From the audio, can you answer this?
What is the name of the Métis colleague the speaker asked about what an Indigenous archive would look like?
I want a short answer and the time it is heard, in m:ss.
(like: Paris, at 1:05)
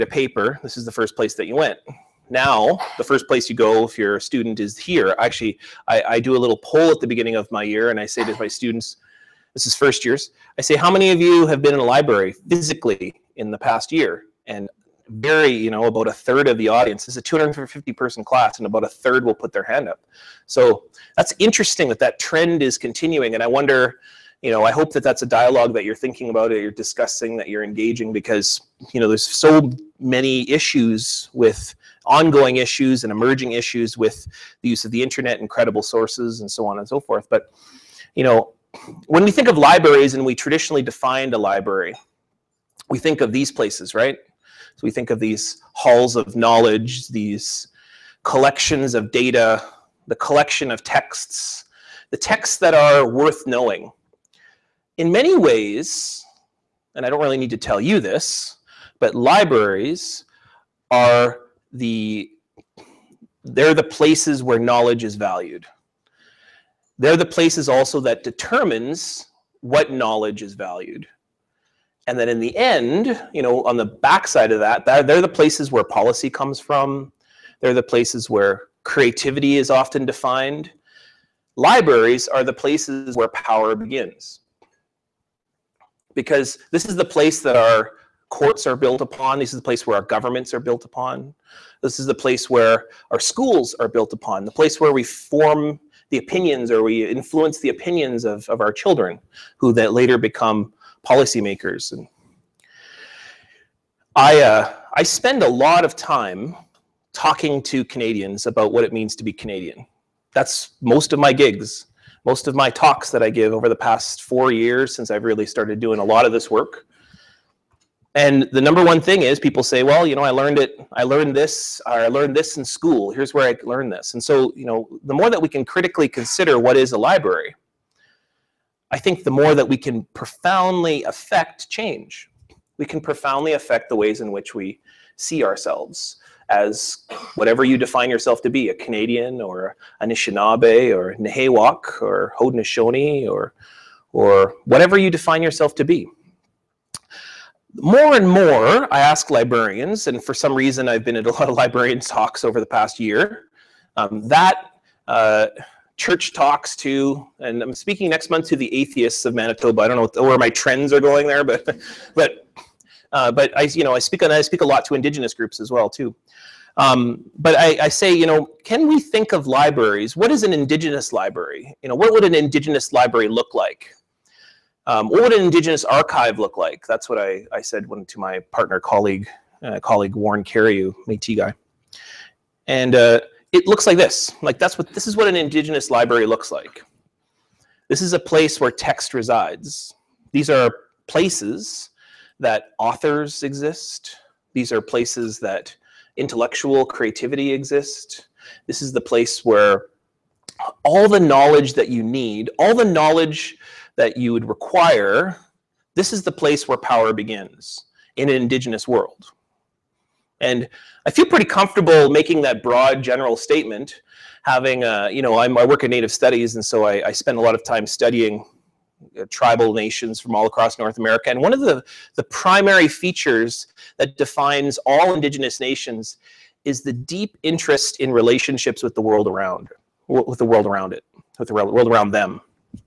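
Warren Cariou, at 3:00.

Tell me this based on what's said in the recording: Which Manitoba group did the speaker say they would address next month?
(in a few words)
The atheists of Manitoba.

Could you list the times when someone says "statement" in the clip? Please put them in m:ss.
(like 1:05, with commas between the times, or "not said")
3:33.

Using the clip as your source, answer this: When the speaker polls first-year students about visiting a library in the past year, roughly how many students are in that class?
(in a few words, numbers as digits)
250.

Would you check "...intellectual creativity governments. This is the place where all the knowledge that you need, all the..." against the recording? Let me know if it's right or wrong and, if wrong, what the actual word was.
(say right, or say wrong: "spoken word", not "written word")
wrong: "exists", not "governments".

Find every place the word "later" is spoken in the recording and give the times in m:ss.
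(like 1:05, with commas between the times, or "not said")
1:39.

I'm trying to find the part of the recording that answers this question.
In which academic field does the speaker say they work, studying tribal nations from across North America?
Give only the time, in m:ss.
3:35.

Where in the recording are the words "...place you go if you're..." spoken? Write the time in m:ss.
0:03.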